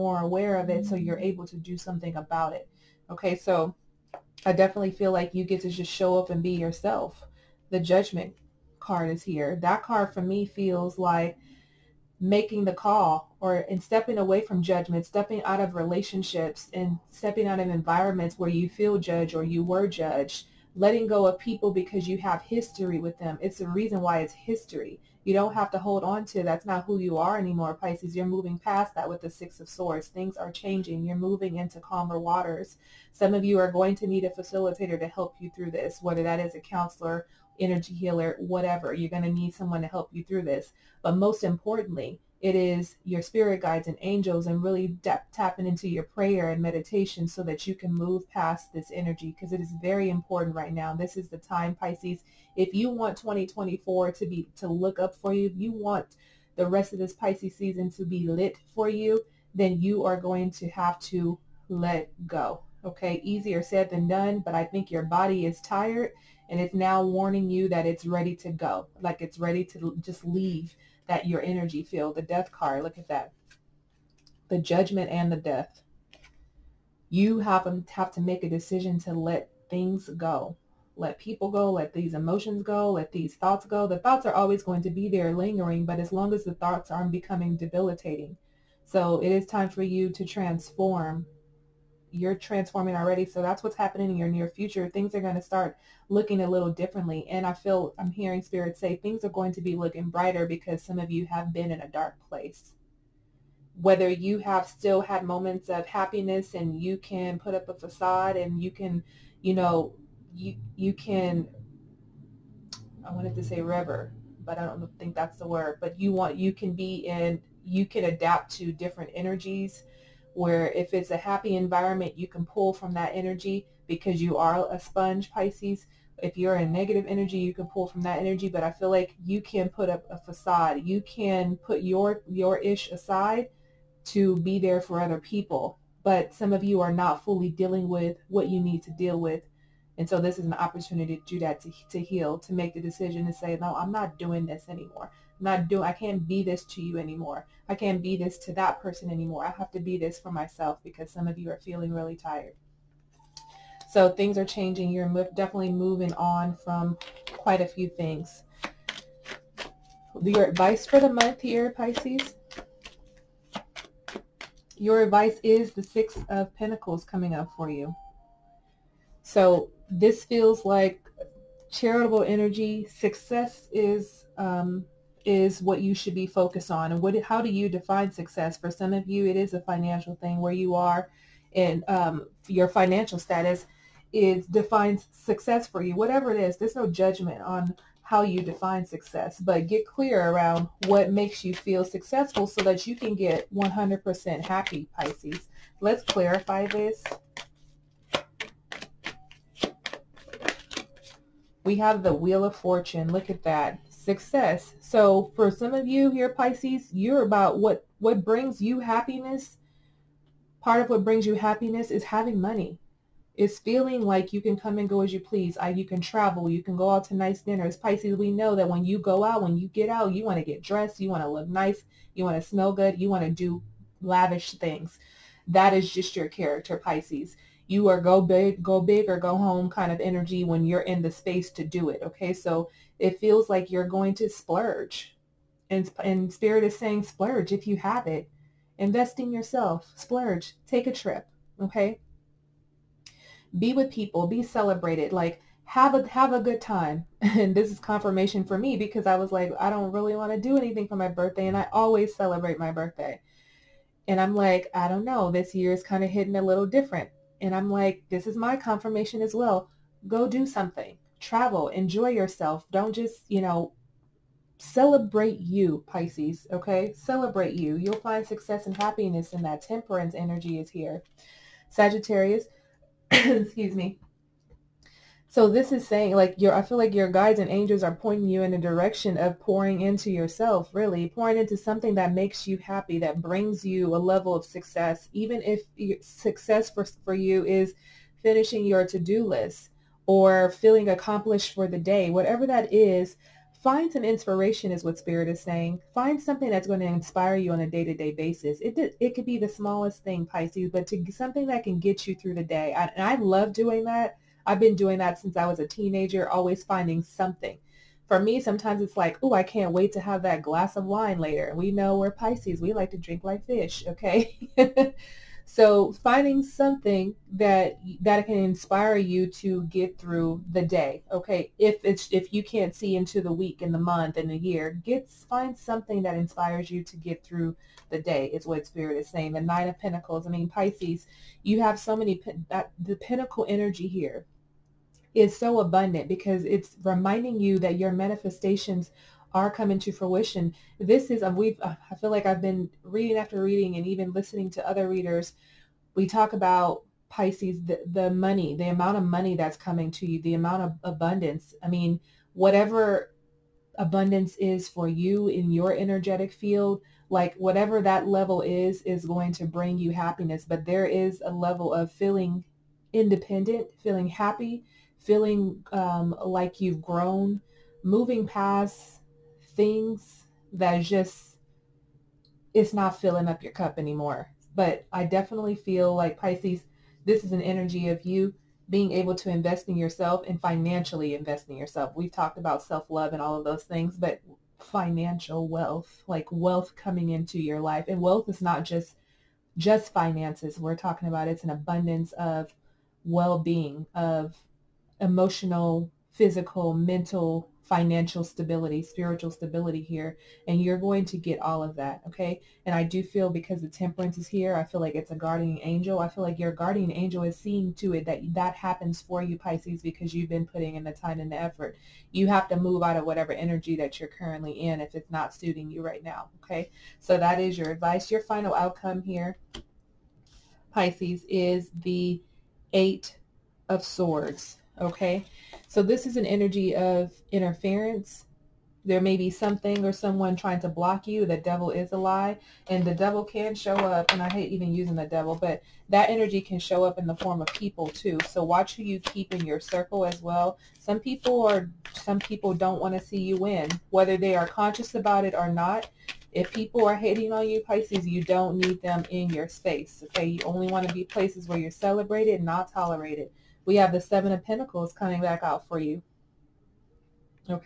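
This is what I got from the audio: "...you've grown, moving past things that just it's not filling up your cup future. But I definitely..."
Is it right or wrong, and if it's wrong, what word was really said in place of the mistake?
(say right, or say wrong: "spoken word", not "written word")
wrong: "anymore", not "future".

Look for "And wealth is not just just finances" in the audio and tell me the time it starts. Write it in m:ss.
6:27.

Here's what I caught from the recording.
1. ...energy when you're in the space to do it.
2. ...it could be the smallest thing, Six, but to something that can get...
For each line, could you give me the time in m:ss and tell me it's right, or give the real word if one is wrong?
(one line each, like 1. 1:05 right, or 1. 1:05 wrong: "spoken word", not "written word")
1. 3:49 right
2. 4:59 wrong: "Pisces", not "Six".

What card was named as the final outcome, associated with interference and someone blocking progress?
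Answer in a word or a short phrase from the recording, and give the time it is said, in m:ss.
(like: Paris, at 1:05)
Eight of Swords, at 7:02.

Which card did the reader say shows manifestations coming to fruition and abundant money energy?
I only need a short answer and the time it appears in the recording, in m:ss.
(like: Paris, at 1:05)
Nine of Pentacles, at 5:29.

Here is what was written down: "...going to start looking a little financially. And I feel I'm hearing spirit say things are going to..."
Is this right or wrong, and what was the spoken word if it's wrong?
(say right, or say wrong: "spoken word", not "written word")
wrong: "differently", not "financially".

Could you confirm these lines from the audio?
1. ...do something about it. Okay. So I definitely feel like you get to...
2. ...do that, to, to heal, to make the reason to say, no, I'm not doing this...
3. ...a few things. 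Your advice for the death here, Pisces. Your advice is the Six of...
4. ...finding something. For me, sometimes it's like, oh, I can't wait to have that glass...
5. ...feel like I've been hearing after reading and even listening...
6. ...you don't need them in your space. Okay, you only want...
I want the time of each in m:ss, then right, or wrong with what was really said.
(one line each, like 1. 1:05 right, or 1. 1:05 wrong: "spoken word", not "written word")
1. 0:01 right
2. 2:21 wrong: "decision", not "reason"
3. 2:37 wrong: "month", not "death"
4. 5:06 right
5. 5:41 wrong: "reading", not "hearing"
6. 7:28 right.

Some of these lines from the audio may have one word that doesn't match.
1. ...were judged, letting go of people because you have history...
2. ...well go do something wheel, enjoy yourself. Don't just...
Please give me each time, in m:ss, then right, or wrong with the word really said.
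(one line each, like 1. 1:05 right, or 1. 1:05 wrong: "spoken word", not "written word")
1. 0:19 right
2. 4:19 wrong: "travel", not "wheel".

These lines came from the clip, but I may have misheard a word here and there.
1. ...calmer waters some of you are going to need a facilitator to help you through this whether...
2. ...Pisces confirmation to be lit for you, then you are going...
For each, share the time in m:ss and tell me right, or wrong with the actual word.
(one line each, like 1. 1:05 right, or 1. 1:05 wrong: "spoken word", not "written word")
1. 0:31 right
2. 0:57 wrong: "season", not "confirmation".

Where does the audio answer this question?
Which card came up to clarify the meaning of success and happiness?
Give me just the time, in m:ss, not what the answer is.
3:22.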